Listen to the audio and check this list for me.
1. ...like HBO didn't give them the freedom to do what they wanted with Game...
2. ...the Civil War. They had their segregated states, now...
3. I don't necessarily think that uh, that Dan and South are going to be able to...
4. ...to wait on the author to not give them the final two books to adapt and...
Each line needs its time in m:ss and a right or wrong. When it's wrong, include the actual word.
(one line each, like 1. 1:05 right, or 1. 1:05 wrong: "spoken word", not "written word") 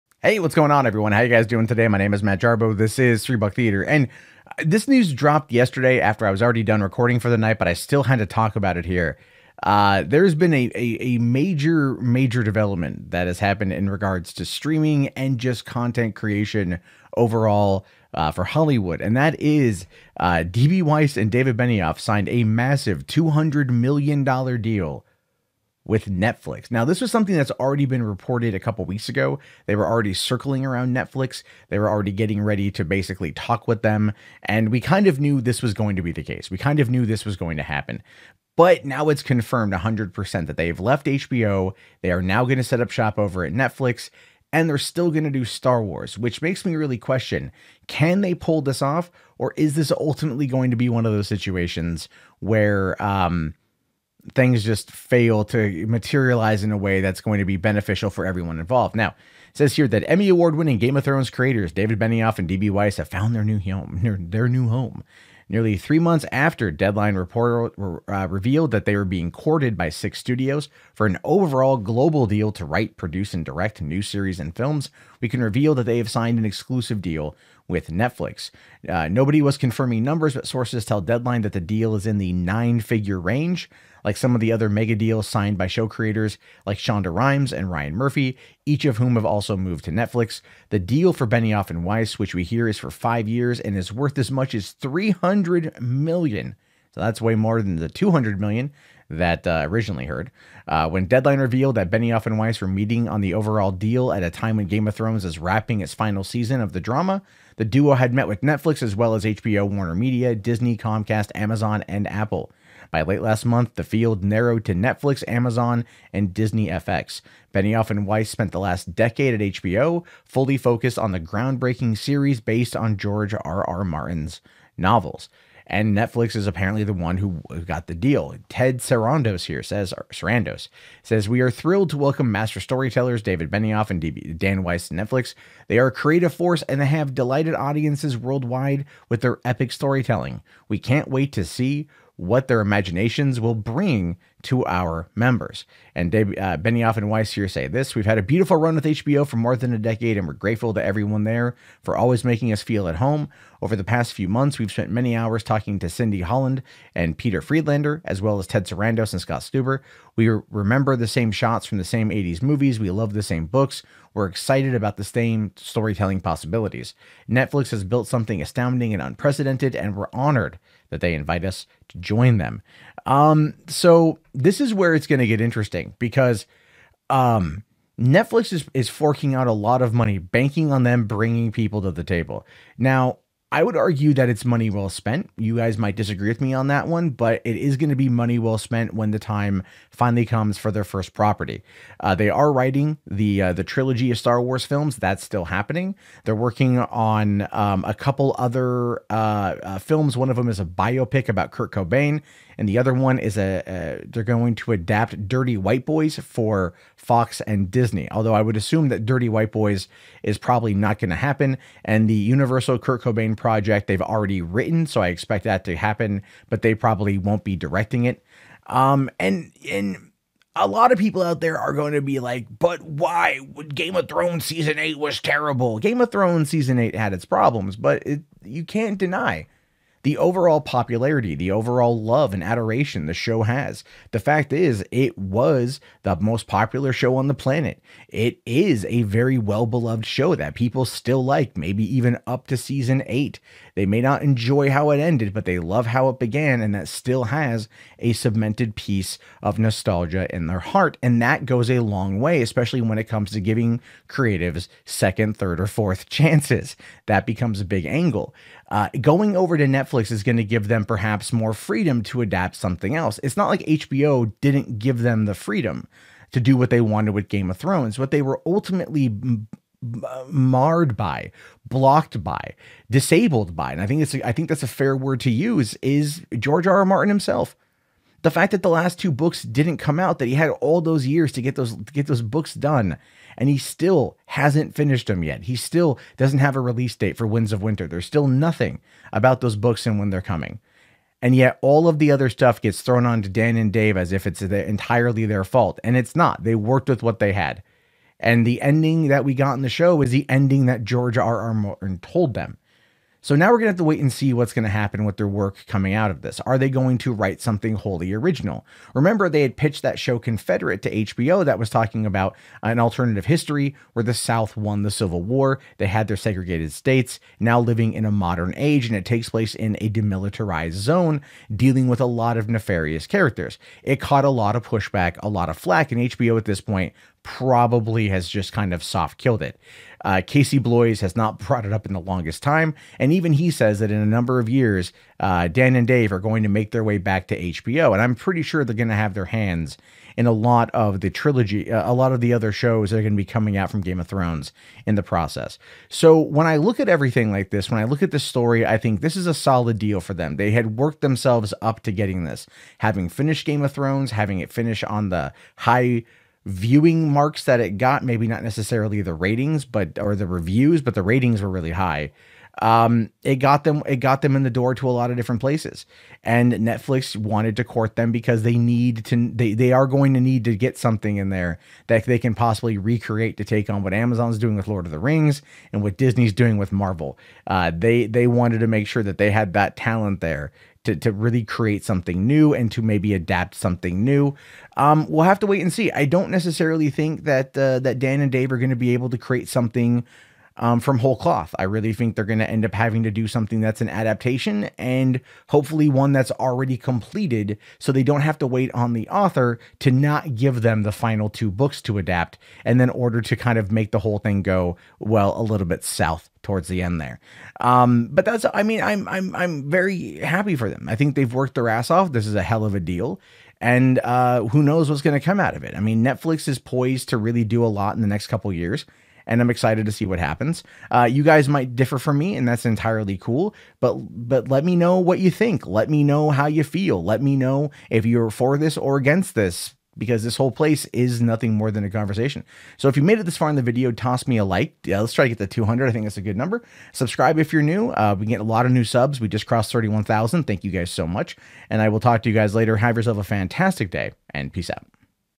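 1. 4:23 right
2. 5:14 right
3. 6:25 wrong: "Dave", not "South"
4. 6:38 right.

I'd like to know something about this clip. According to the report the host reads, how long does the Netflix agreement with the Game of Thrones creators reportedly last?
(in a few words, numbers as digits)
5 years.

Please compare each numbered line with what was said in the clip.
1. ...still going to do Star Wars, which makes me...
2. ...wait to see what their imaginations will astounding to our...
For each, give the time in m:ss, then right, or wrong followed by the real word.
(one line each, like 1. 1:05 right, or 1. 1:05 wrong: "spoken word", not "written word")
1. 0:44 right
2. 2:21 wrong: "bring", not "astounding".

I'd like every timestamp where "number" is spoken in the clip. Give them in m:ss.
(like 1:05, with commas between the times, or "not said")
1:20, 5:34, 7:16.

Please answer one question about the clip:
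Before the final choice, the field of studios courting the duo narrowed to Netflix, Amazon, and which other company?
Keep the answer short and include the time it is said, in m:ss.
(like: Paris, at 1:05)
Disney FX, at 1:56.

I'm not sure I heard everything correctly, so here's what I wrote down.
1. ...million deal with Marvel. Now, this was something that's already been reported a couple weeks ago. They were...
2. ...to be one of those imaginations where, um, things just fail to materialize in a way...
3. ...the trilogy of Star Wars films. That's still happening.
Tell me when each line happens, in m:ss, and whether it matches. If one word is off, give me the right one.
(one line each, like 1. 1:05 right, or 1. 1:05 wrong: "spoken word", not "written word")
1. 0:23 wrong: "Netflix", not "Marvel"
2. 0:50 wrong: "situations", not "imaginations"
3. 3:13 right.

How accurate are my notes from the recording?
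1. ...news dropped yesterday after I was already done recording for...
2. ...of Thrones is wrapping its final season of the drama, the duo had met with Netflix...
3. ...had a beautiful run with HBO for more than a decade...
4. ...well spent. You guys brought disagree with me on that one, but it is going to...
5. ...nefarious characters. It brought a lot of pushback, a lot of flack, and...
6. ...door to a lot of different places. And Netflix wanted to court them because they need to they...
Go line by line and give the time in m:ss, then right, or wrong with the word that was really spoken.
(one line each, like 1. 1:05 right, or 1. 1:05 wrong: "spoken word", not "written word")
1. 0:04 right
2. 1:44 right
3. 2:28 right
4. 3:04 wrong: "might", not "brought"
5. 5:22 wrong: "caught", not "brought"
6. 6:04 right.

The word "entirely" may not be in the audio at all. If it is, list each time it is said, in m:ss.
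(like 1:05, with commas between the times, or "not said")
4:54, 7:02.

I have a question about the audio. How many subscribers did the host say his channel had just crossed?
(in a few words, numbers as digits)
31,000.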